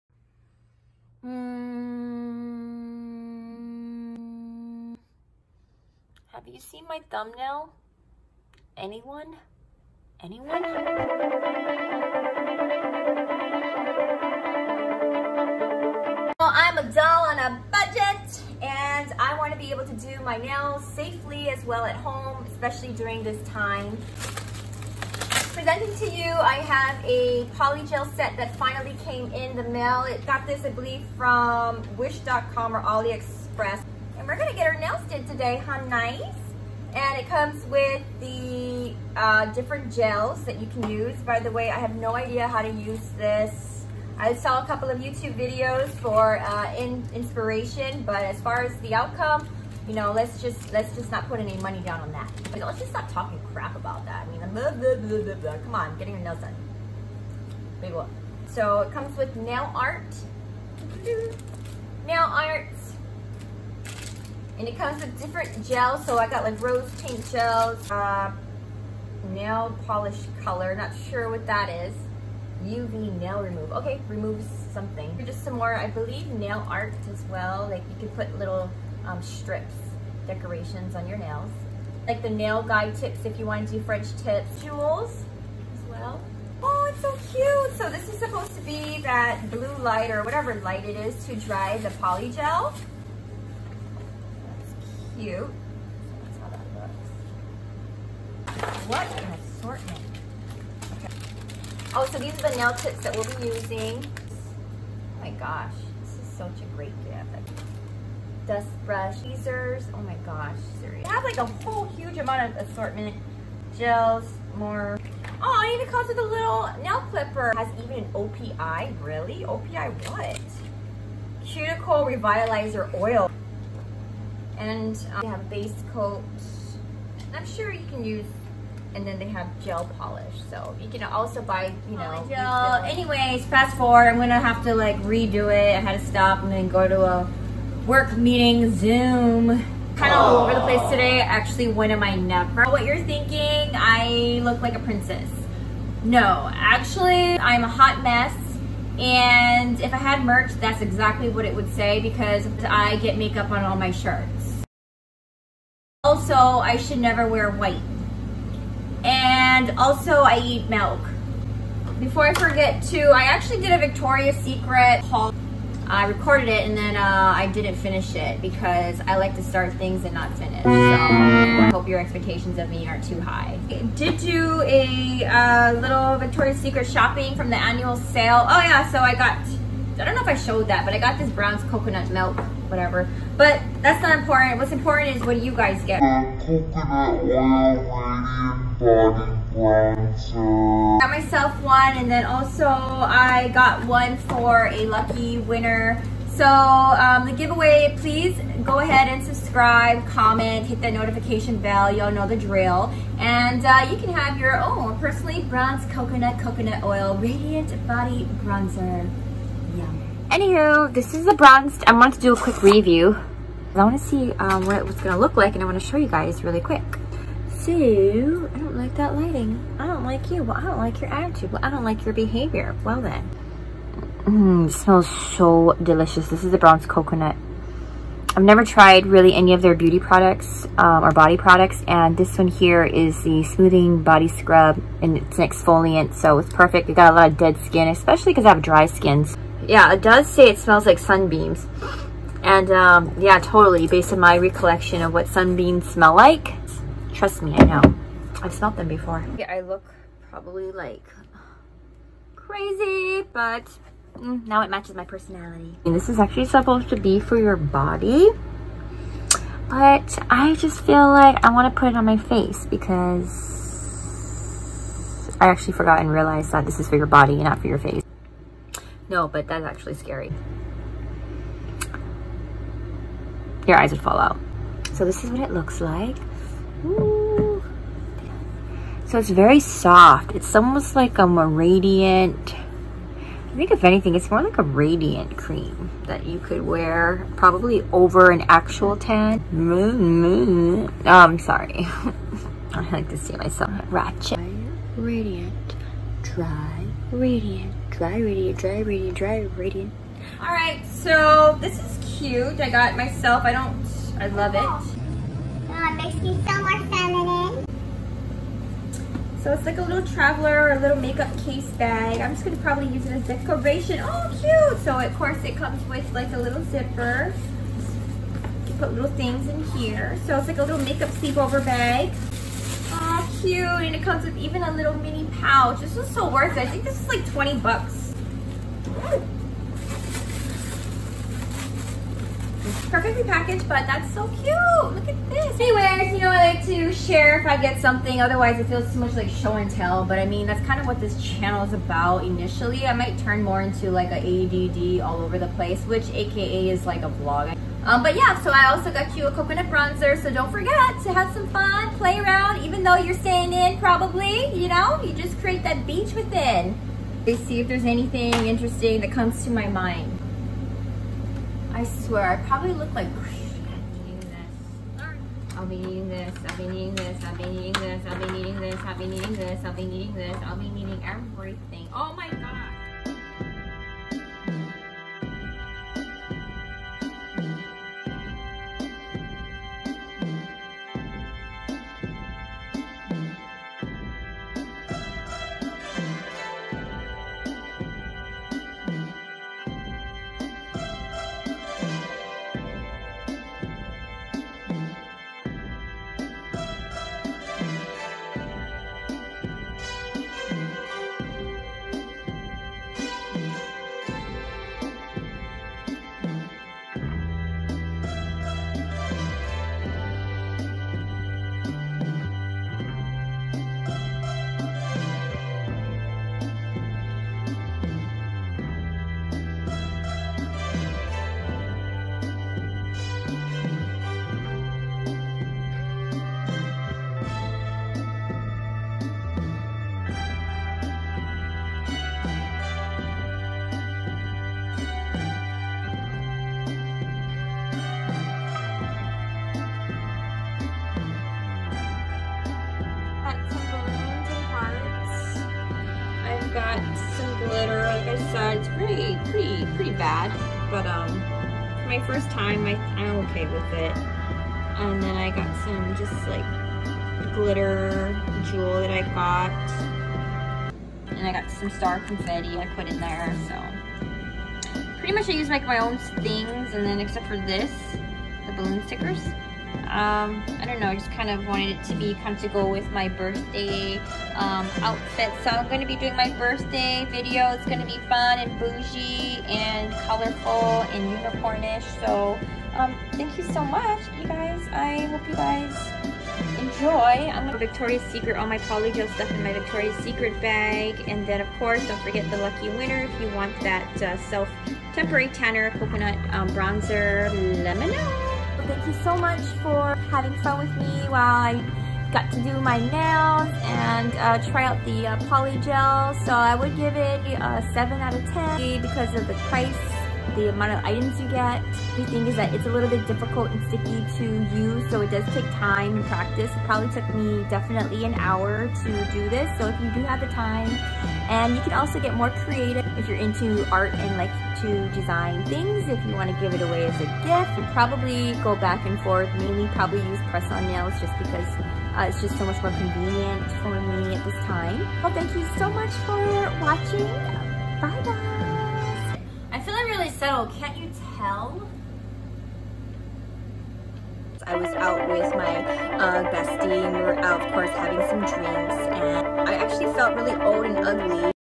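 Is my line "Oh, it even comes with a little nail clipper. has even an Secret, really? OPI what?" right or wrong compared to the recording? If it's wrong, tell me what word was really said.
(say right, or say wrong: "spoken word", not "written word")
wrong: "OPI", not "Secret".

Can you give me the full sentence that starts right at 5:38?
Otherwise, it feels too much like show and tell.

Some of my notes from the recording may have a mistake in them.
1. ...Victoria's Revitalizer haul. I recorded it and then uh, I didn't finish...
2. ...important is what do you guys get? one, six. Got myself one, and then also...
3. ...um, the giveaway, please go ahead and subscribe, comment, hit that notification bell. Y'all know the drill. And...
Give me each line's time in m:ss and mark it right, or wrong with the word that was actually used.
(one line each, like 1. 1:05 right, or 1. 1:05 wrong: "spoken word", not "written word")
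1. 2:43 wrong: "Secret", not "Revitalizer"
2. 3:04 wrong: "two", not "six"
3. 3:16 right.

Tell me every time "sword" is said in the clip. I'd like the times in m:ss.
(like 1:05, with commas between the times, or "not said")
not said.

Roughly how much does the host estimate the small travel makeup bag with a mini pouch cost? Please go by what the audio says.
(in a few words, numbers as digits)
20 bucks.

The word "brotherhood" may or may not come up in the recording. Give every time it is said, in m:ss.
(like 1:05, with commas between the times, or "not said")
not said.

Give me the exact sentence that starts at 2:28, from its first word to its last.
And if I had merch, that's exactly what it would say because I get makeup on all my shirts.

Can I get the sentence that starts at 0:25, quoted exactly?
Presenting to you, I have a polygel set that finally came in the mail.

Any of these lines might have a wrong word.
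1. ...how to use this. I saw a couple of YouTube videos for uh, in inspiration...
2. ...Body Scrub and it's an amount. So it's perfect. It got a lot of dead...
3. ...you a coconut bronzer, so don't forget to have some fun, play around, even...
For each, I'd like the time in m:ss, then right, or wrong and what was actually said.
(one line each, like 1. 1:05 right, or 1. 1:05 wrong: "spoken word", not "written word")
1. 0:42 right
2. 3:54 wrong: "exfoliant", not "amount"
3. 5:49 right.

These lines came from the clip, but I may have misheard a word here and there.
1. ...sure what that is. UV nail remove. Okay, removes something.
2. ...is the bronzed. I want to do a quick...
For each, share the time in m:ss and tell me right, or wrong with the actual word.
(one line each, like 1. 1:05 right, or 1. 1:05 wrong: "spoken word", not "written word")
1. 1:11 right
2. 3:31 right.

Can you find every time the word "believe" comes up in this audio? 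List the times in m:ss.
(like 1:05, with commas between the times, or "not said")
0:30, 1:15.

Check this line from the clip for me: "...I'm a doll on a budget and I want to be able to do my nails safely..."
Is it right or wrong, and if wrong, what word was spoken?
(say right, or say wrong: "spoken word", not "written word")
right.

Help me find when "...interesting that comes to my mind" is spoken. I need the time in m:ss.
5:58.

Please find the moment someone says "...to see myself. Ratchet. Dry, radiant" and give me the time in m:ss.
4:53.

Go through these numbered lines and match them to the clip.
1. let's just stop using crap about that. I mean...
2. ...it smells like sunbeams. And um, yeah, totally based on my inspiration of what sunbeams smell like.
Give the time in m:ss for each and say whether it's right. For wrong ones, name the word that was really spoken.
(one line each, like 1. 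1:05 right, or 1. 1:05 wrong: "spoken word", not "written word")
1. 0:52 wrong: "talking", not "using"
2. 4:00 wrong: "recollection", not "inspiration".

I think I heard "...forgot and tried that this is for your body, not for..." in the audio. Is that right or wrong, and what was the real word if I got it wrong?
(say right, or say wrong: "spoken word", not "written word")
wrong: "realized", not "tried".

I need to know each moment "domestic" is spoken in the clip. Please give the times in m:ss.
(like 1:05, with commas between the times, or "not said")
not said.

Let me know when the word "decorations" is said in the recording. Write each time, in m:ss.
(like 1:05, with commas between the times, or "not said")
1:20, 5:13.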